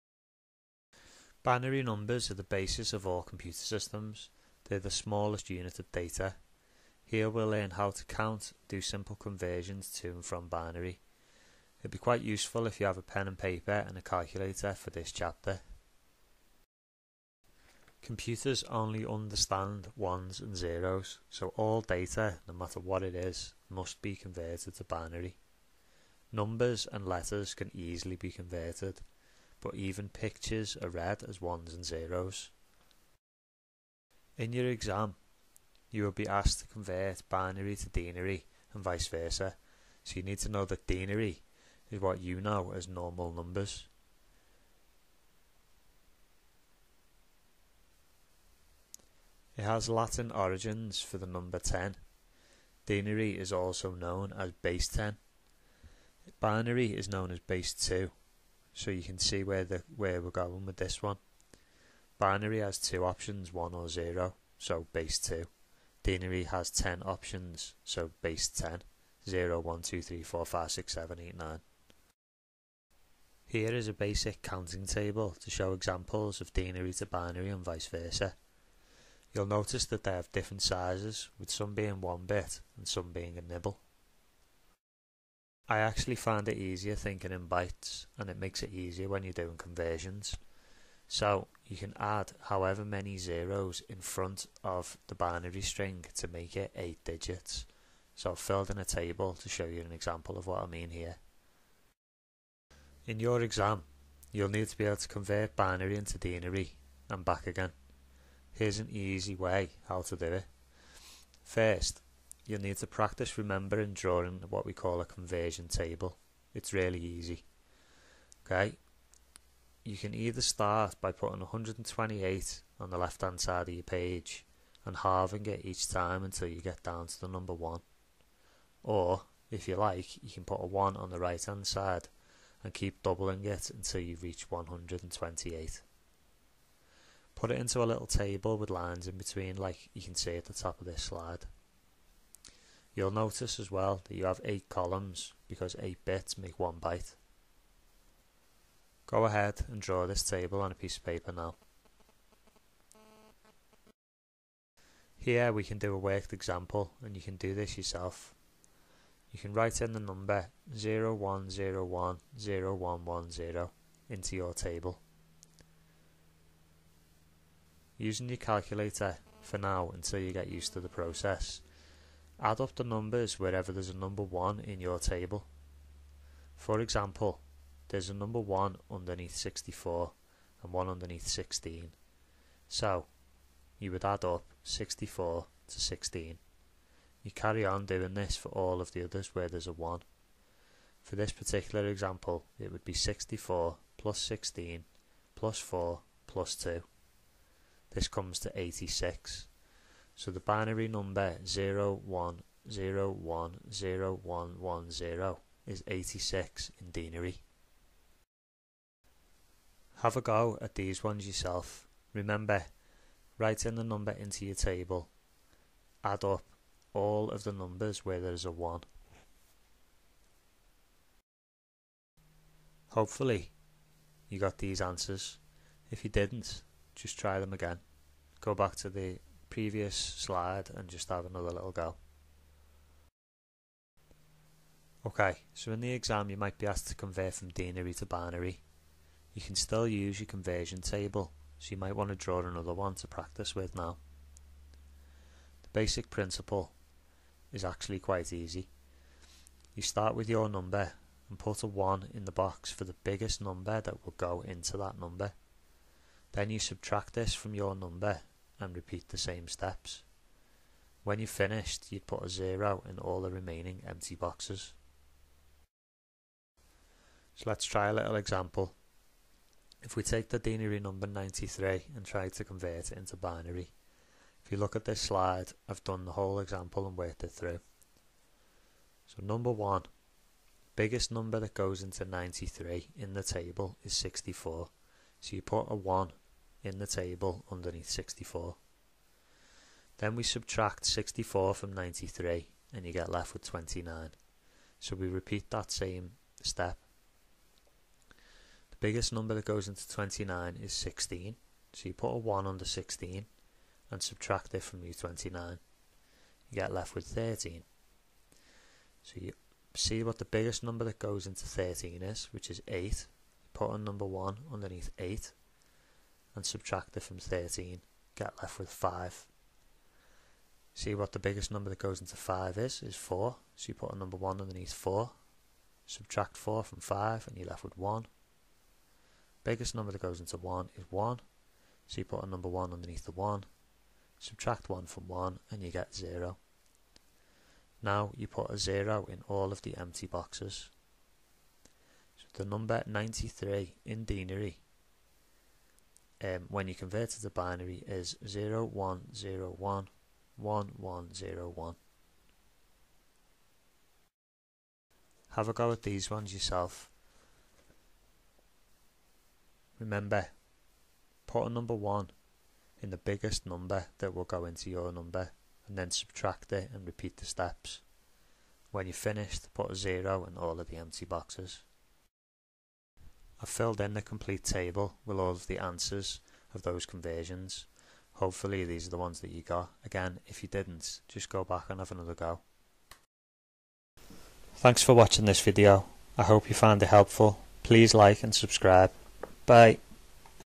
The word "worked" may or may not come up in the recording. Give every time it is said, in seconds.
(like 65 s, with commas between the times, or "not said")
155 s, 276 s.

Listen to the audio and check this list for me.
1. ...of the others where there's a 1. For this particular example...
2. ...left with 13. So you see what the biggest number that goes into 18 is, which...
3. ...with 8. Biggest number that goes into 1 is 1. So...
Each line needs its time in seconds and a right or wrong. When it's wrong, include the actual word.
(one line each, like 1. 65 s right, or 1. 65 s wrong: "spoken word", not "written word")
1. 188 s right
2. 306 s wrong: "13", not "18"
3. 327 s wrong: "1", not "8".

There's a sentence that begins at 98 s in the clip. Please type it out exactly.
So I've filled in a table to show you an example of what I mean here.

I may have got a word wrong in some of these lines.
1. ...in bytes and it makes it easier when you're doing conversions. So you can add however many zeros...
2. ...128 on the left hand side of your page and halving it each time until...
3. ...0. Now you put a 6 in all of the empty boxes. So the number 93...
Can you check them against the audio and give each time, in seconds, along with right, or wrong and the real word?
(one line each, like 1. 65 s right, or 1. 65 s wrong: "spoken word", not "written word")
1. 87 s right
2. 121 s right
3. 335 s wrong: "0", not "6".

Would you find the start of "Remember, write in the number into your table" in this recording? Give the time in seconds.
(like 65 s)
212 s.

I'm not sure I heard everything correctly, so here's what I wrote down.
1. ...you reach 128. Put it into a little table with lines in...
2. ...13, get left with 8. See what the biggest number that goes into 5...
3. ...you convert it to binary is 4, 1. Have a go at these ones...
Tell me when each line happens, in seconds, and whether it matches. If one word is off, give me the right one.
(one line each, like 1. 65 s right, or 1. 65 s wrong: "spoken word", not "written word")
1. 134 s right
2. 317 s wrong: "5", not "8"
3. 346 s wrong: "0", not "4".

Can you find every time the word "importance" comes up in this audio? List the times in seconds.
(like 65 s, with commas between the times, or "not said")
not said.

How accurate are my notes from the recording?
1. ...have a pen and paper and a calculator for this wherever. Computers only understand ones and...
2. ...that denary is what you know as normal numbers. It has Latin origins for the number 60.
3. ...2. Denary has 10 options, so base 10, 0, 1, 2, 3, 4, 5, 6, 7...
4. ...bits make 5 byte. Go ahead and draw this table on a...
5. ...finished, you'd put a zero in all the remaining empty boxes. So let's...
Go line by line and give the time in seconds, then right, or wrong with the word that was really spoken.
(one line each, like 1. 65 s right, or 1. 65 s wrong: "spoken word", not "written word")
1. 12 s wrong: "chapter", not "wherever"
2. 40 s wrong: "10", not "60"
3. 65 s right
4. 146 s wrong: "1", not "5"
5. 261 s right.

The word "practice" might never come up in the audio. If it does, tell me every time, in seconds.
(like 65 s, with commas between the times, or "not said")
112 s, 243 s.